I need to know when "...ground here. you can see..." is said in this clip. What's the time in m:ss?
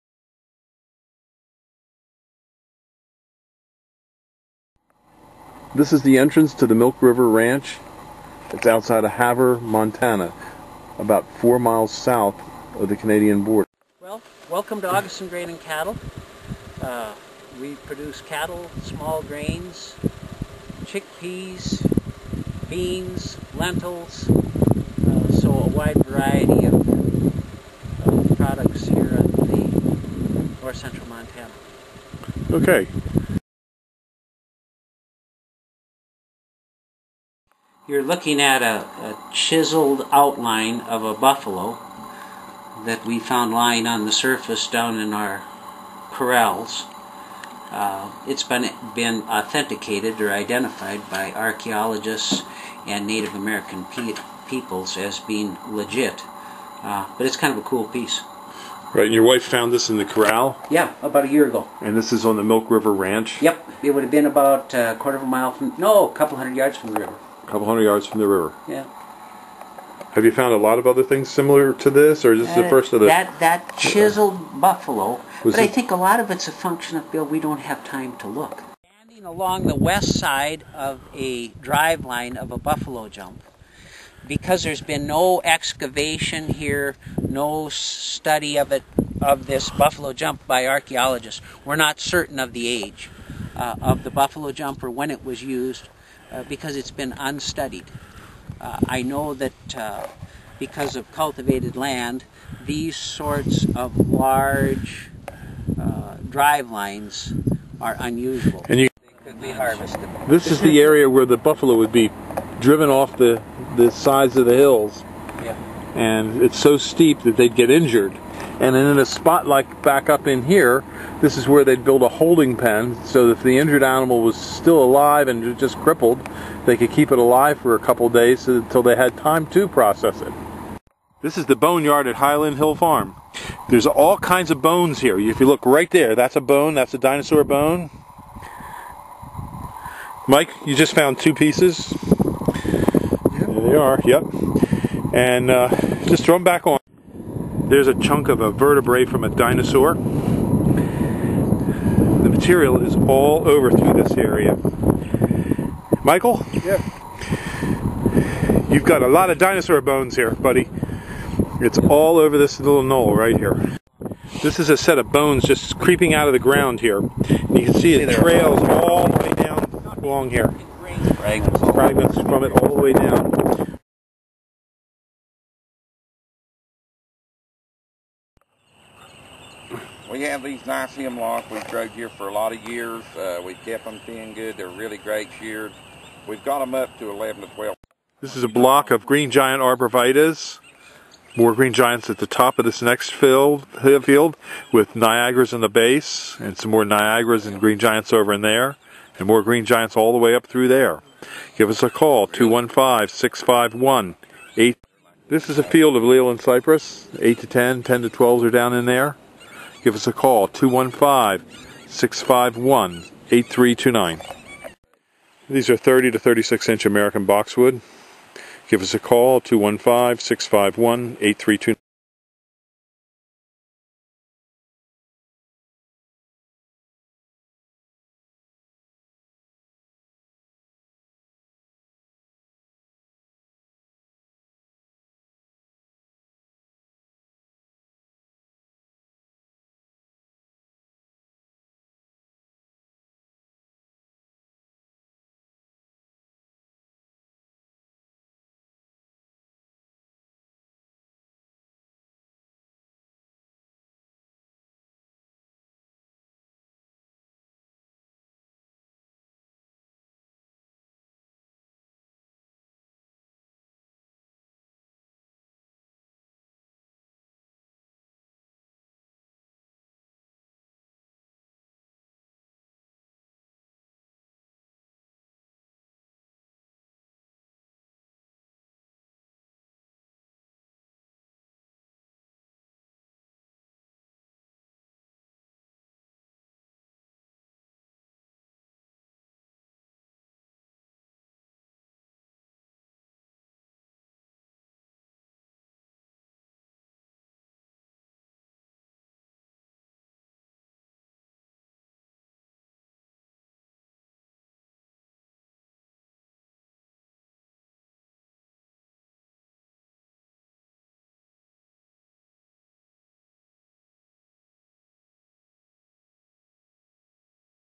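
2:46.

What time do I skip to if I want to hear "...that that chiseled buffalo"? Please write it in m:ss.
1:13.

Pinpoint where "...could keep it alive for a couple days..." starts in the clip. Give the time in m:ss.
2:06.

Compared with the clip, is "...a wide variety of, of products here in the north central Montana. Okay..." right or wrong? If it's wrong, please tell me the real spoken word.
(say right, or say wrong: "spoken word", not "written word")
right.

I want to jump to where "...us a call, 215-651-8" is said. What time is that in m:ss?
3:21.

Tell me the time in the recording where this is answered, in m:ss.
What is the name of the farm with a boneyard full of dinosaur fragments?
2:12.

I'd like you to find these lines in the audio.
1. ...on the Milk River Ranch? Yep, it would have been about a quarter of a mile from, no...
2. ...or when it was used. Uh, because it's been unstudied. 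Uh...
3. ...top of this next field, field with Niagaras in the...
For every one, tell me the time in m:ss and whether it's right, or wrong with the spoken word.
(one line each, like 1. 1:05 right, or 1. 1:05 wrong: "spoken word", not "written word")
1. 1:02 right
2. 1:34 right
3. 3:12 right.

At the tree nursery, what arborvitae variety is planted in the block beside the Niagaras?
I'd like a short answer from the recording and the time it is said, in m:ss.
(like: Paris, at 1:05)
Green Giant, at 3:09.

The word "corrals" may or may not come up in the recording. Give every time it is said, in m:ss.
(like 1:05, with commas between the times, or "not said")
0:46, 1:00.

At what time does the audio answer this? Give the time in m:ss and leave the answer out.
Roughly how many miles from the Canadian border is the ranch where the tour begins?
0:11.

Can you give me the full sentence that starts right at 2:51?
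Fragments from it all the way down.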